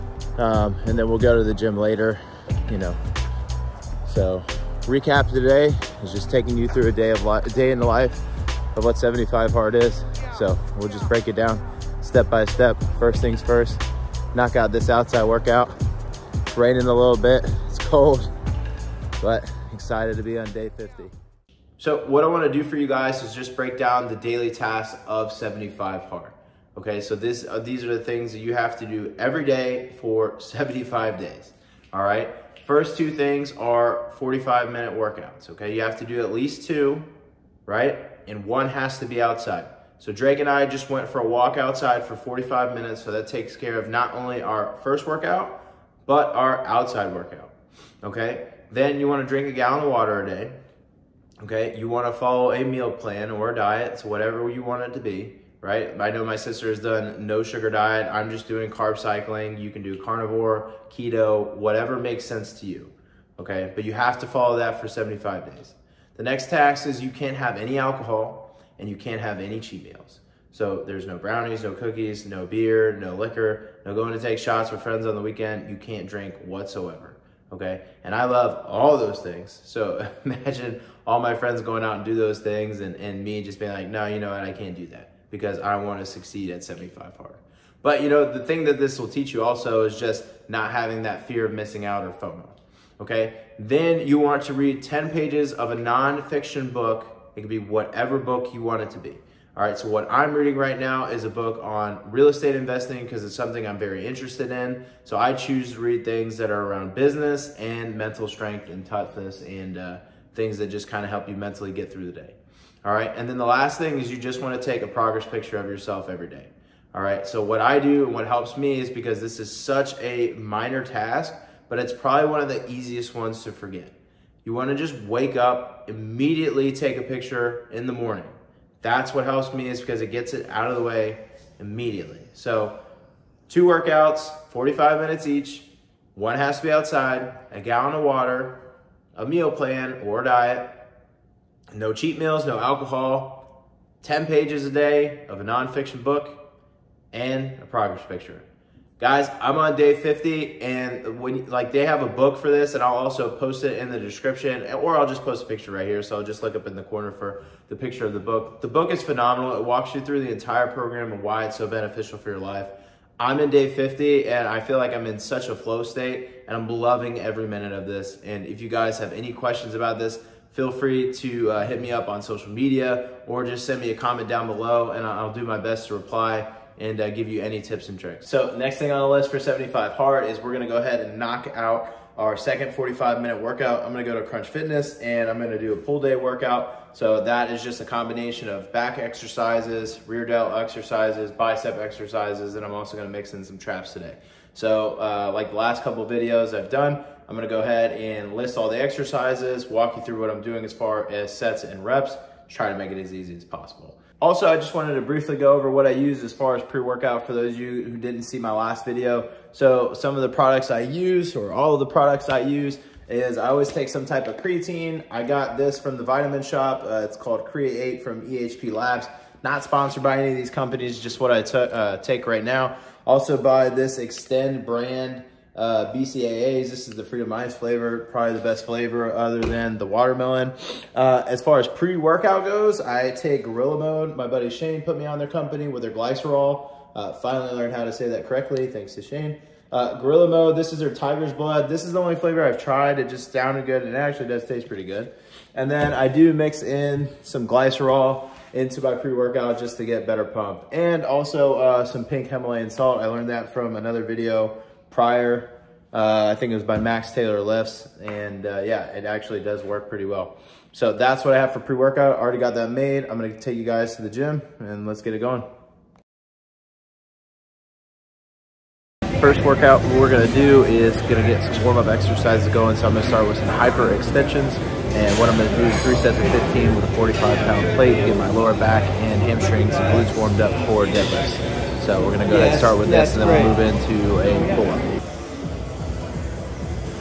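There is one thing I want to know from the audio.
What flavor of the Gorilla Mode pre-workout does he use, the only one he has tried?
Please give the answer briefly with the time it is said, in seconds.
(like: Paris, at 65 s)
Tiger's Blood, at 240 s.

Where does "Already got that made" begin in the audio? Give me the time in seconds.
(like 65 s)
262 s.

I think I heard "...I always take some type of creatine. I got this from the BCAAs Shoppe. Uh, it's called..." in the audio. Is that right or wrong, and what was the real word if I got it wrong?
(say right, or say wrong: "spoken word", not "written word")
wrong: "Vitamin", not "BCAAs".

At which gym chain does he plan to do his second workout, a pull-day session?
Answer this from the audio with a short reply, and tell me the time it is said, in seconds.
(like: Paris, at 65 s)
Crunch Fitness, at 184 s.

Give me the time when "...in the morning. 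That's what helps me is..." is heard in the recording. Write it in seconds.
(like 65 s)
127 s.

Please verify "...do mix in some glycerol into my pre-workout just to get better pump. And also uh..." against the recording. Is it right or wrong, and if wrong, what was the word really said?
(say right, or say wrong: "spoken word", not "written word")
right.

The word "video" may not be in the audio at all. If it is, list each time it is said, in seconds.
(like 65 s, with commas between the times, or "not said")
196 s, 208 s, 254 s.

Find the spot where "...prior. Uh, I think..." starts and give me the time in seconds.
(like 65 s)
254 s.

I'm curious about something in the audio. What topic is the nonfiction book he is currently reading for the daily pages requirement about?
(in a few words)
real estate investing.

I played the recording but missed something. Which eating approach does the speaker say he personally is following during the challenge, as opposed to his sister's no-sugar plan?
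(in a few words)
carb cycling.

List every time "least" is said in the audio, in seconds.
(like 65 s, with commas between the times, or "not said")
36 s.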